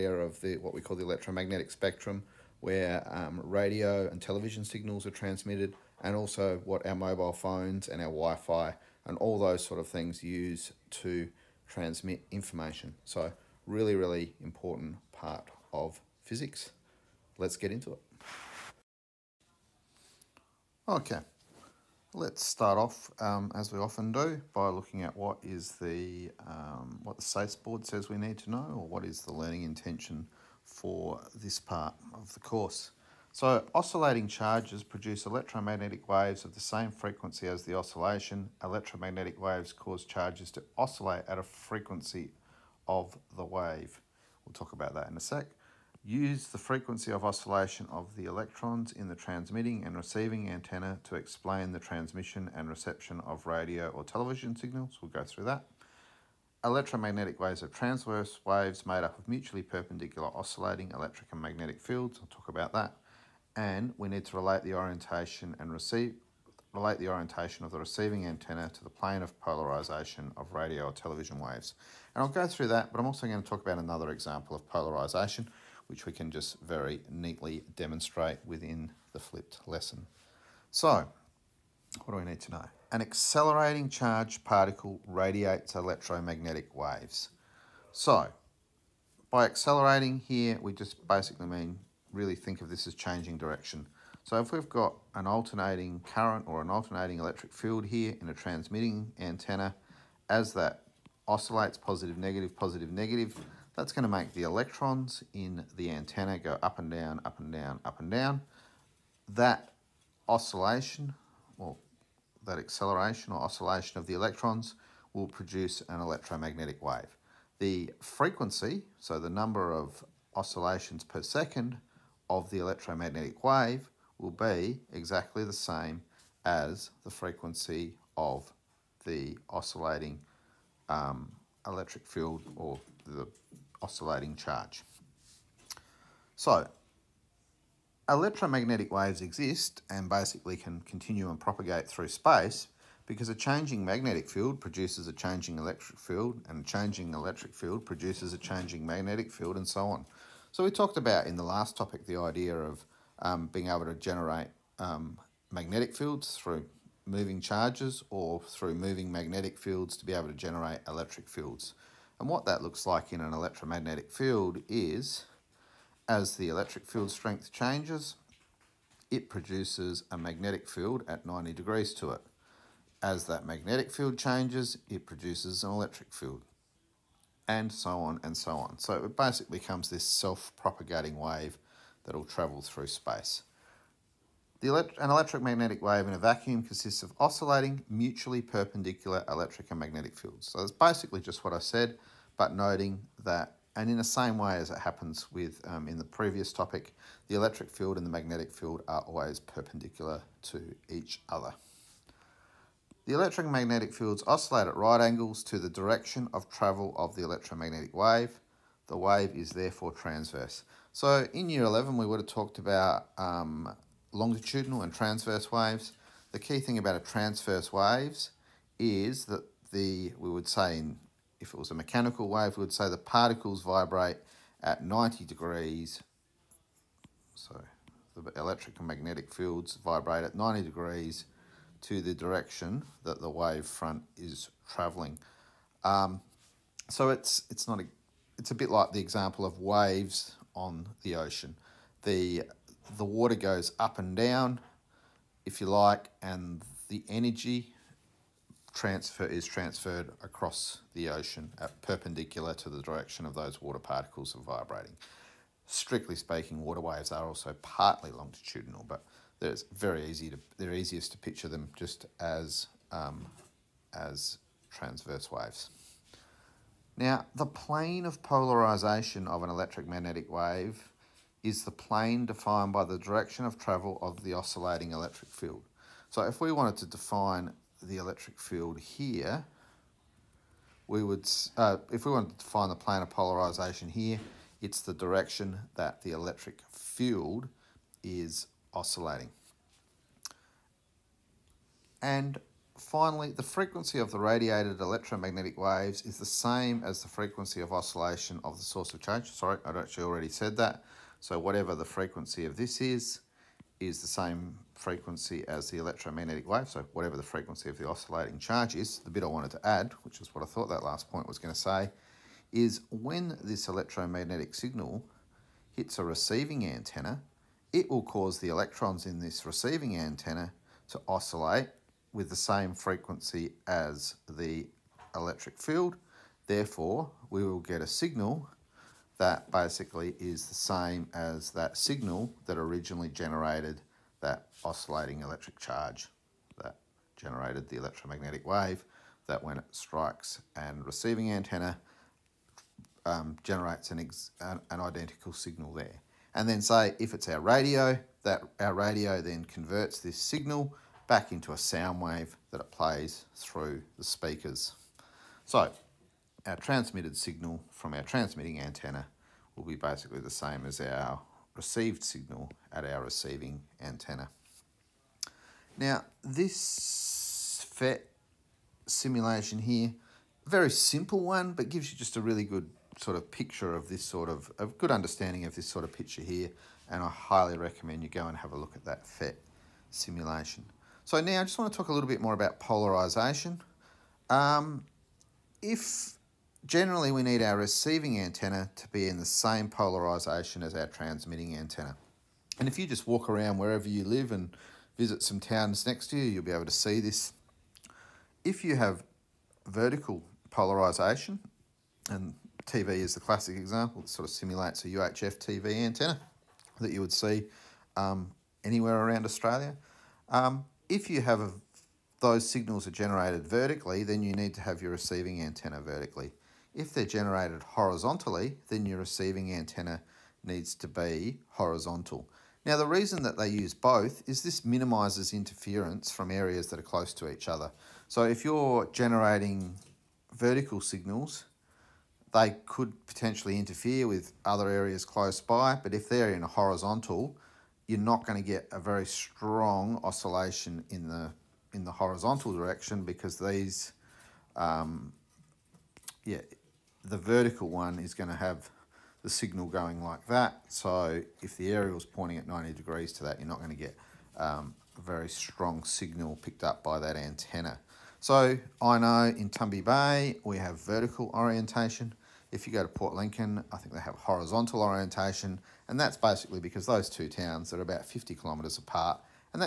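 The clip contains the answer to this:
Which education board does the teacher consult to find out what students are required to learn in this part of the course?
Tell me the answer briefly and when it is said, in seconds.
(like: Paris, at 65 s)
SACE board, at 27 s.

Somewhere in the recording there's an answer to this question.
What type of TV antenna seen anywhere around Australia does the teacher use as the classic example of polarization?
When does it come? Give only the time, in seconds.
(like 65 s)
404 s.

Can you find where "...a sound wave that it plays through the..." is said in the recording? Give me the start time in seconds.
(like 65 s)
351 s.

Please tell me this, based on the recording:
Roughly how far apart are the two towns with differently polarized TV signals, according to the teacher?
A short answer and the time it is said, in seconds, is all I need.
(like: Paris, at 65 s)
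50 kilometres, at 468 s.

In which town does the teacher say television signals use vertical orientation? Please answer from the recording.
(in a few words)
Tumby Bay.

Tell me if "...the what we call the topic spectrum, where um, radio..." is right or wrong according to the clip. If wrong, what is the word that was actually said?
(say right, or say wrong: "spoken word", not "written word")
wrong: "electromagnetic", not "topic".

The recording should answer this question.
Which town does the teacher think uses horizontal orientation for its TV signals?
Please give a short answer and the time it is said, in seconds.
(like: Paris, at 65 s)
Port Lincoln, at 462 s.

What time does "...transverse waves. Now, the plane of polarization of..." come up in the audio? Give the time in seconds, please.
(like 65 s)
264 s.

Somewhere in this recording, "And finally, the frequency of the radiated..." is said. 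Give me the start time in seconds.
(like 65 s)
292 s.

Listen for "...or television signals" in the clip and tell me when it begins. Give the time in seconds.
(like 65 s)
53 s.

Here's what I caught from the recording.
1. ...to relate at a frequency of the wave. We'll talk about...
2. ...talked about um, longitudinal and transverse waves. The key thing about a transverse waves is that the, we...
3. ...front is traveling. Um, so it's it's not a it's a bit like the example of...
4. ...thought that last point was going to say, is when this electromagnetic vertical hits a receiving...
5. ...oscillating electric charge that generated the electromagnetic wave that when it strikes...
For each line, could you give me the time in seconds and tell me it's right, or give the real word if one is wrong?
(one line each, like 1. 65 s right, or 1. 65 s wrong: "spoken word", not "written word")
1. 40 s wrong: "oscillate", not "relate"
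2. 212 s right
3. 233 s right
4. 310 s wrong: "signal", not "vertical"
5. 334 s right.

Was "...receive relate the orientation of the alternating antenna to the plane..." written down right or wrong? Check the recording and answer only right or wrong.
wrong.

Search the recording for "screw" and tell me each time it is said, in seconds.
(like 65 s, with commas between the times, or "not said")
not said.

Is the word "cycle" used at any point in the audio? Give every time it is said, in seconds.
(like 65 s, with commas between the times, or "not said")
not said.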